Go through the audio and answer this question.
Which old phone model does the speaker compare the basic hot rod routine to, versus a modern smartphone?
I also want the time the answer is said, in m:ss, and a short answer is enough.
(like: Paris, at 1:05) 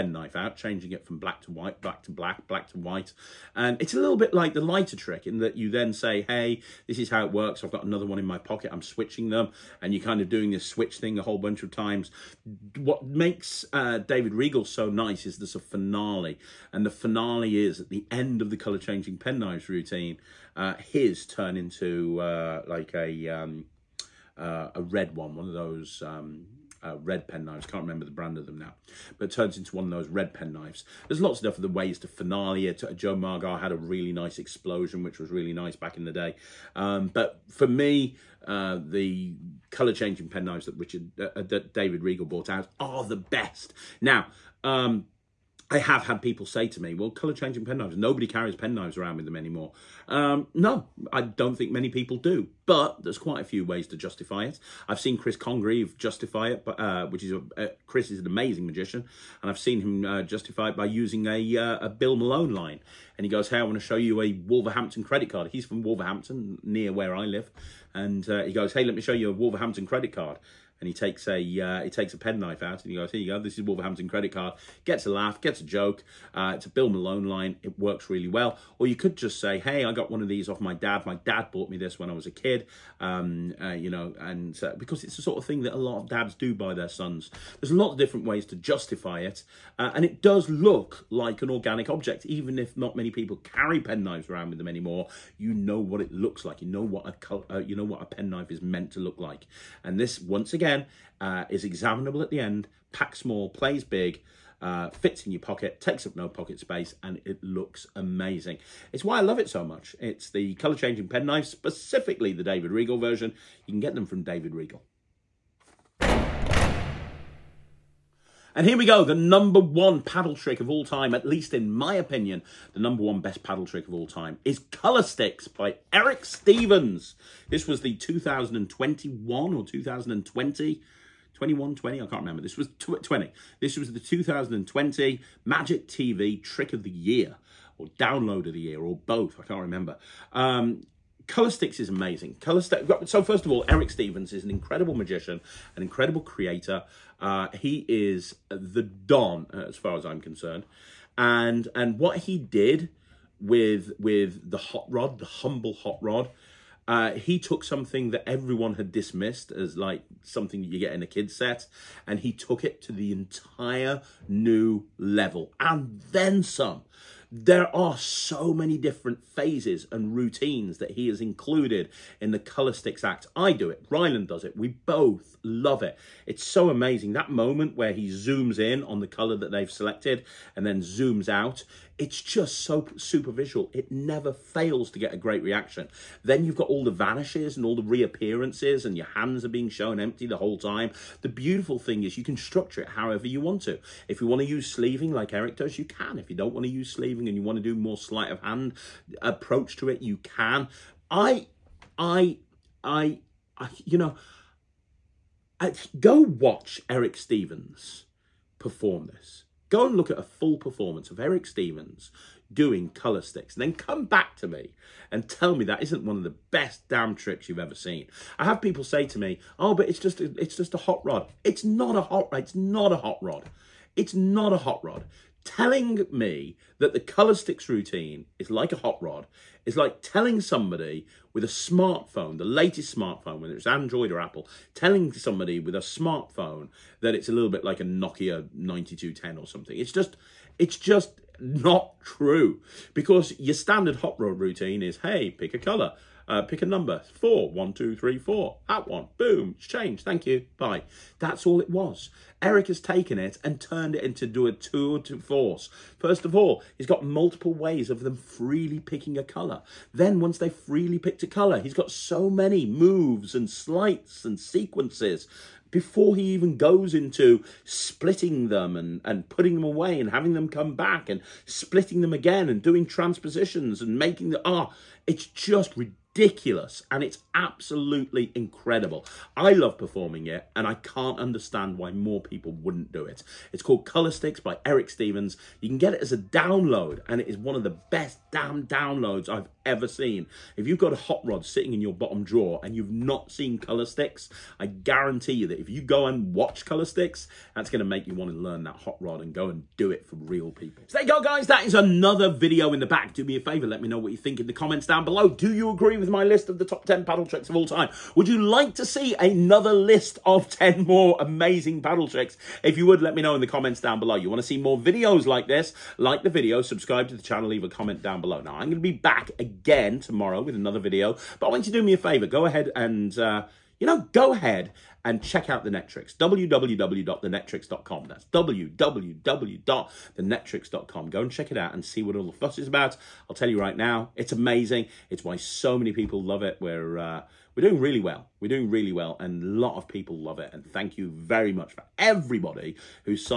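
Nokia 9210, at 3:57.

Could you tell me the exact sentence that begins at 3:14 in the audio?
If you want to use sleeving like Eric does, you can.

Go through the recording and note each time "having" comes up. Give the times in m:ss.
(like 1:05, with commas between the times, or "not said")
4:30.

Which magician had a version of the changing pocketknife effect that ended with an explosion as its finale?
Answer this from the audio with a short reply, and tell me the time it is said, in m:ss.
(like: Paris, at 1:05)
Joe Mogar, at 0:32.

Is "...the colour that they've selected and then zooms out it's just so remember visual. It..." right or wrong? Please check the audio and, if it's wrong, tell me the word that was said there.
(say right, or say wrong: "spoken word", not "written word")
wrong: "super", not "remember".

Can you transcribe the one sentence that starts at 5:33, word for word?
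I'll tell you right now, it's amazing.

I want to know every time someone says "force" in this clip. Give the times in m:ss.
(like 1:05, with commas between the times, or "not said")
4:15.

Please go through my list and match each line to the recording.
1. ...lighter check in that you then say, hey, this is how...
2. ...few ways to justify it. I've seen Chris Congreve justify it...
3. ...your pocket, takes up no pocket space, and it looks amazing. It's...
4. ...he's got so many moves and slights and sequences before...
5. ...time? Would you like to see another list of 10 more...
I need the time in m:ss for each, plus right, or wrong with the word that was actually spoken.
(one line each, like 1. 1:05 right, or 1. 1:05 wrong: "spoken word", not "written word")
1. 0:04 wrong: "trick", not "check"
2. 0:53 right
3. 1:45 right
4. 4:21 right
5. 5:07 right.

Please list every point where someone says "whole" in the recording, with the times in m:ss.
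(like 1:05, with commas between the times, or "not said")
0:11, 3:10.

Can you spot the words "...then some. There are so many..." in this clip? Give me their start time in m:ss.
2:46.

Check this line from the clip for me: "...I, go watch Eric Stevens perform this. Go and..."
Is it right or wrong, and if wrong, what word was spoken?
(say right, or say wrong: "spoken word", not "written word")
right.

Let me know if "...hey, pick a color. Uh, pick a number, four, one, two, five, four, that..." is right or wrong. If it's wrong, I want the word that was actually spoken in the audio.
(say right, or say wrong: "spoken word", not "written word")
wrong: "three", not "five".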